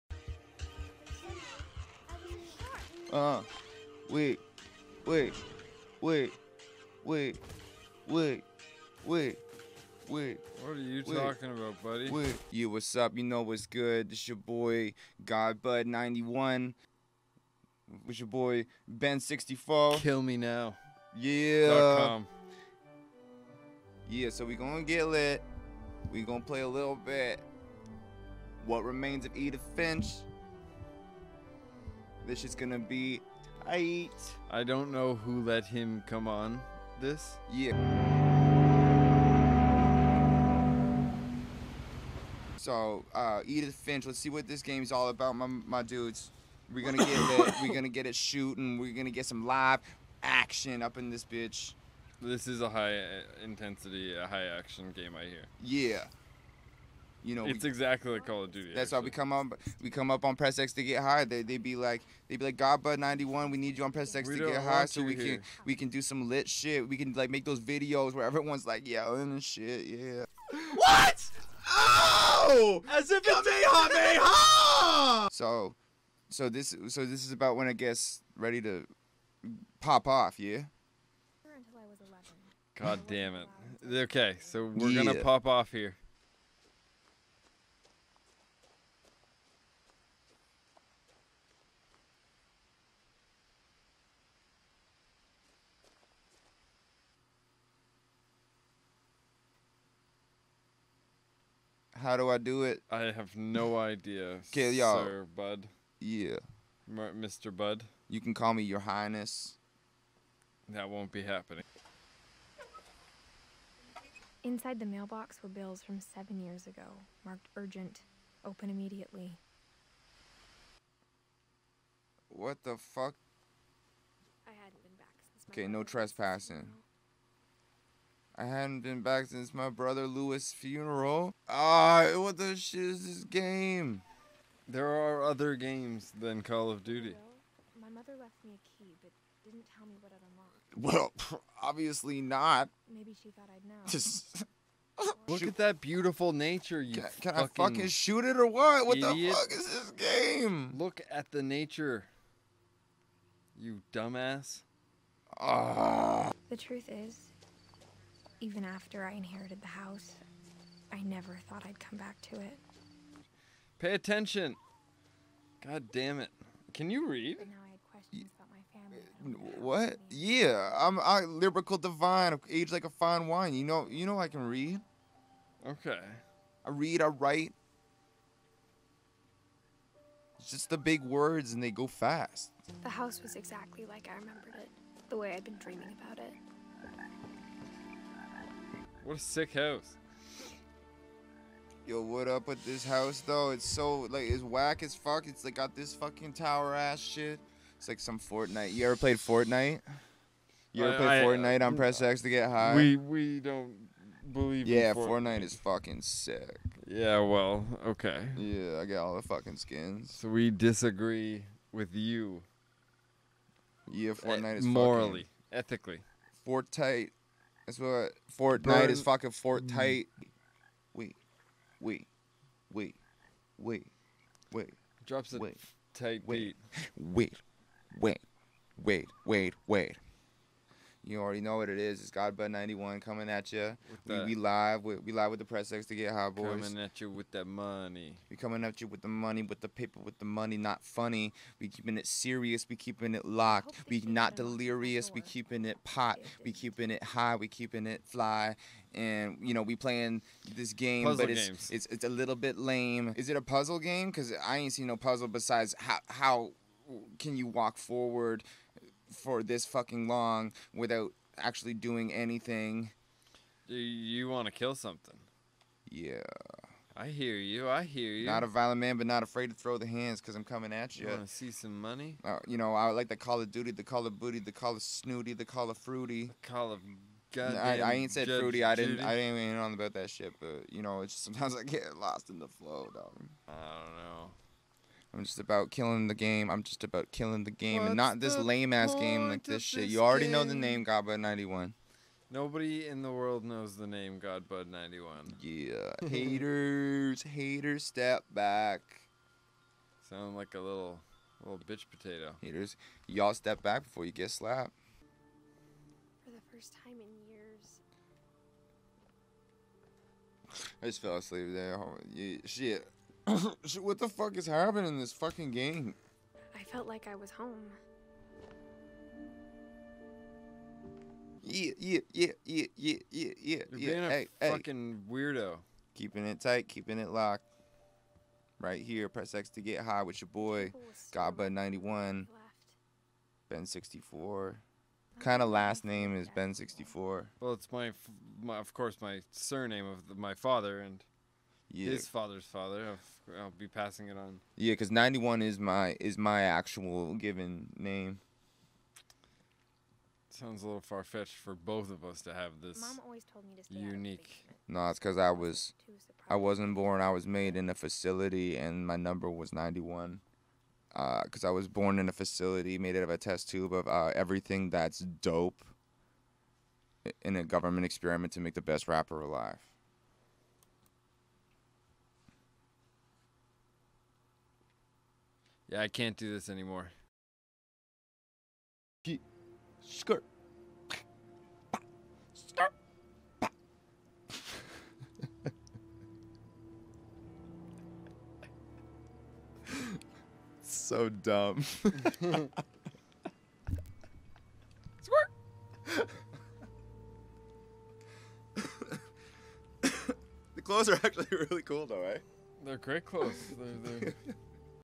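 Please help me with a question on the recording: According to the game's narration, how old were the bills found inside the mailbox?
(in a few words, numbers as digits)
7.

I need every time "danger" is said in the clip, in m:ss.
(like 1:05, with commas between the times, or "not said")
not said.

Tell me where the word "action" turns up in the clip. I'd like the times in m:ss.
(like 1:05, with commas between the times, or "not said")
0:50, 0:54.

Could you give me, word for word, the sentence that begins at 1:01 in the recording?
They they be like they be like Godbud ninety one.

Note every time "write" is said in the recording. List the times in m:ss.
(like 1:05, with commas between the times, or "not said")
2:57.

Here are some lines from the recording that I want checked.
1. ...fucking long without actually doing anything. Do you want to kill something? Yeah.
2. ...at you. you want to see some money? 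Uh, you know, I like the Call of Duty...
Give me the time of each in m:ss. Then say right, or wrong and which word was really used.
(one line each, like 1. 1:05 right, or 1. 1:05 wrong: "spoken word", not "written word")
1. 4:19 right
2. 4:30 right.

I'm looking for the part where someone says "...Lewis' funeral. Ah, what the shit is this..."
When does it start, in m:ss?
2:10.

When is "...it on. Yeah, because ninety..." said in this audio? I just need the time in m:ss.
5:44.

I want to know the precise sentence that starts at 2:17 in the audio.
My mother left me a key, but didn't tell me what it unlocked.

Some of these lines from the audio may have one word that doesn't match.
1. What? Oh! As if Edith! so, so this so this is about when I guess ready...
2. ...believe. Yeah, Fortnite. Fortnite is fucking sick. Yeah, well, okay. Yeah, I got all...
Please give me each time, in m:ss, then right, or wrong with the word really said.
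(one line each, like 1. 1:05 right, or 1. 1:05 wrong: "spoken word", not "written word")
1. 1:10 wrong: "Kamehameha", not "Edith"
2. 3:24 right.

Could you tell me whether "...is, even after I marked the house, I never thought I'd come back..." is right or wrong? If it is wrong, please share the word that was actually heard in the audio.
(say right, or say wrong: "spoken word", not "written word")
wrong: "inherited", not "marked".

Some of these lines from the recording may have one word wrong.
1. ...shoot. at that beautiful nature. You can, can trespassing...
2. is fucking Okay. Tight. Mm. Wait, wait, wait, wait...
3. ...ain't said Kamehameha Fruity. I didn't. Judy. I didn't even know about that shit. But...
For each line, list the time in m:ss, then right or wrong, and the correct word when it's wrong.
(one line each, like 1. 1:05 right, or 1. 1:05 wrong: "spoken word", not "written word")
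1. 2:25 wrong: "fucking", not "trespassing"
2. 3:38 wrong: "Fortnite", not "Okay"
3. 4:37 wrong: "Judge", not "Kamehameha".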